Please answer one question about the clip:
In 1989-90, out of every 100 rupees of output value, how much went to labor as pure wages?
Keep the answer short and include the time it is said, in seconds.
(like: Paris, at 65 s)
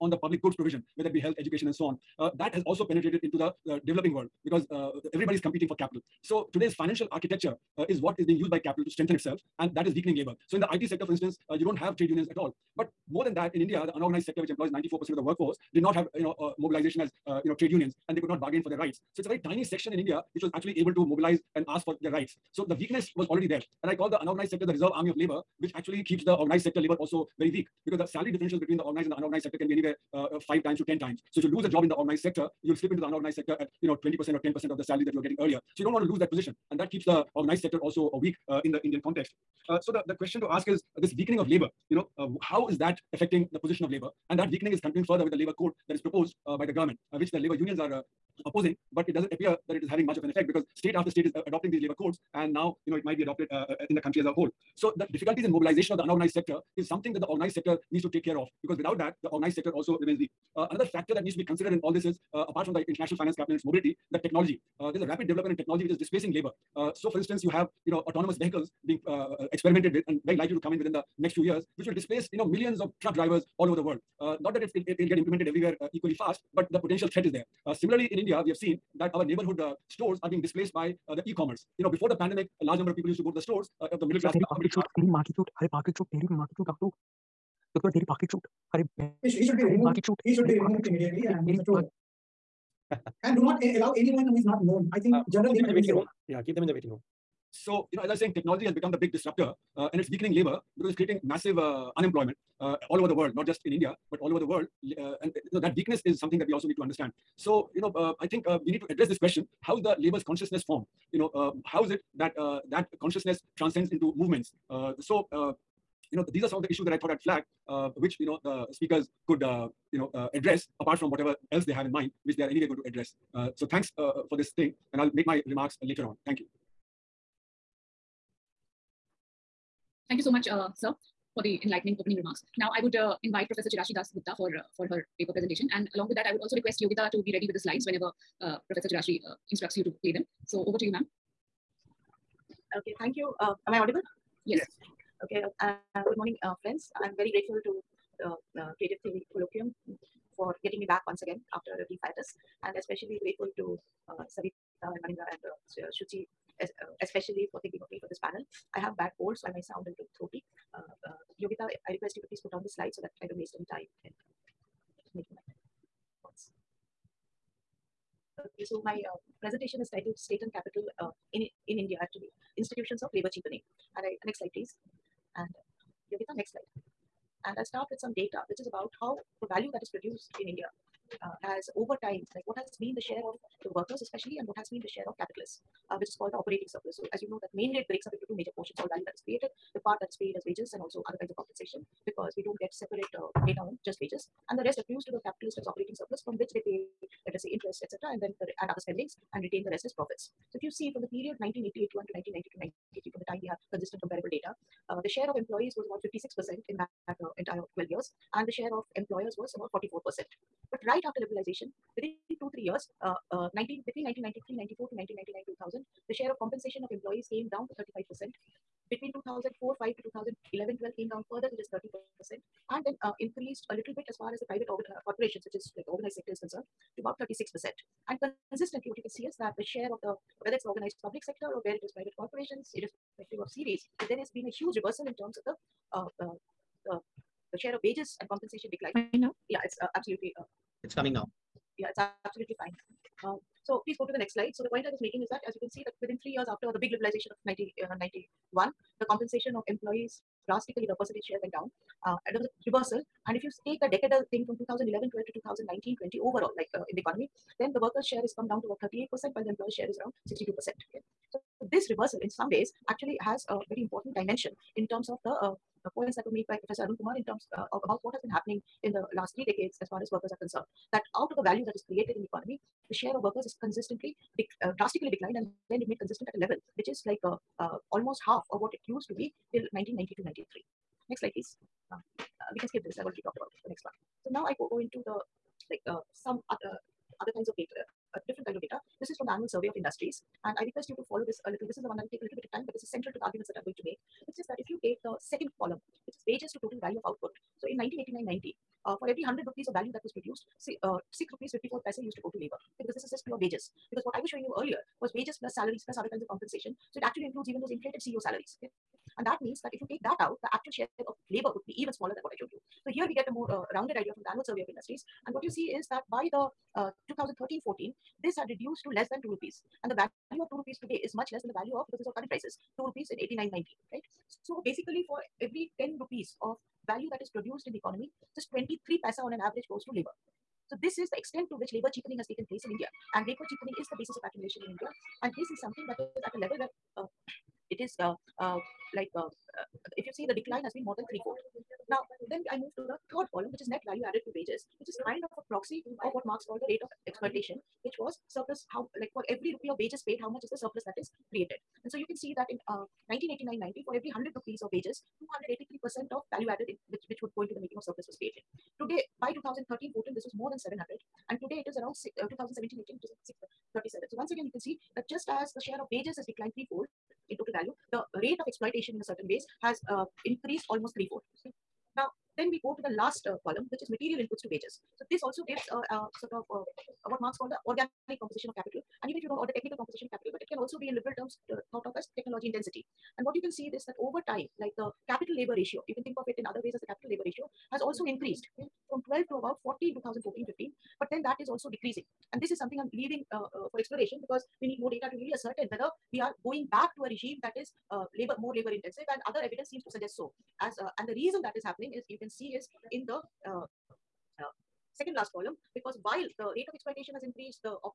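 6 rupees 54 paise, at 301 s.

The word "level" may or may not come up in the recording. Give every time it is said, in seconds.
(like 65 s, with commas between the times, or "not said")
276 s, 336 s.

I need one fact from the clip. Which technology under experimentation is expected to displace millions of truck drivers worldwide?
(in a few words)
autonomous vehicles.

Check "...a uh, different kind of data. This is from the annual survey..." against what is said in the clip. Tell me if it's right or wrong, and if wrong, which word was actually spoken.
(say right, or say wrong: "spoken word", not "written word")
right.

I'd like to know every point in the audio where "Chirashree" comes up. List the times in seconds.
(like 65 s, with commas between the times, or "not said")
133 s, 138 s.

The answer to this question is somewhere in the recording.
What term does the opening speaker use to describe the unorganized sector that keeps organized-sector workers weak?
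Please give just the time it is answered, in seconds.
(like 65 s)
24 s.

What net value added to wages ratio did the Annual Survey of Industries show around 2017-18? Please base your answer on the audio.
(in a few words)
637.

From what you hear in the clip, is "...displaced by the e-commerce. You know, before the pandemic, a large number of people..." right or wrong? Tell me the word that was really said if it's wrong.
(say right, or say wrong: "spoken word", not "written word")
right.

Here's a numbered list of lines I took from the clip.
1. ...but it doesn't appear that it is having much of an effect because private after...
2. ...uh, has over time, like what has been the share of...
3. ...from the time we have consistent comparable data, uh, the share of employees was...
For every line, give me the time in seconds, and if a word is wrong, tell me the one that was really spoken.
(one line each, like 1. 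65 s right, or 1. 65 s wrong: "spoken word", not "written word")
1. 48 s wrong: "state", not "private"
2. 181 s right
3. 203 s right.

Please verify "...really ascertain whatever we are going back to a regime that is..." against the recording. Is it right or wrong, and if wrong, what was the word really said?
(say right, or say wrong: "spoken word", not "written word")
wrong: "whether", not "whatever".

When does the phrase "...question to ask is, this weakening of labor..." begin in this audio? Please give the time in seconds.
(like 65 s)
40 s.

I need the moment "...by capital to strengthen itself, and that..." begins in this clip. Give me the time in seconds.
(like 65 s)
8 s.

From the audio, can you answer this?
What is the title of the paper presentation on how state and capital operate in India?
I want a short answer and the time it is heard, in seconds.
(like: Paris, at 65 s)
Institutions of Labor Cheapening, at 172 s.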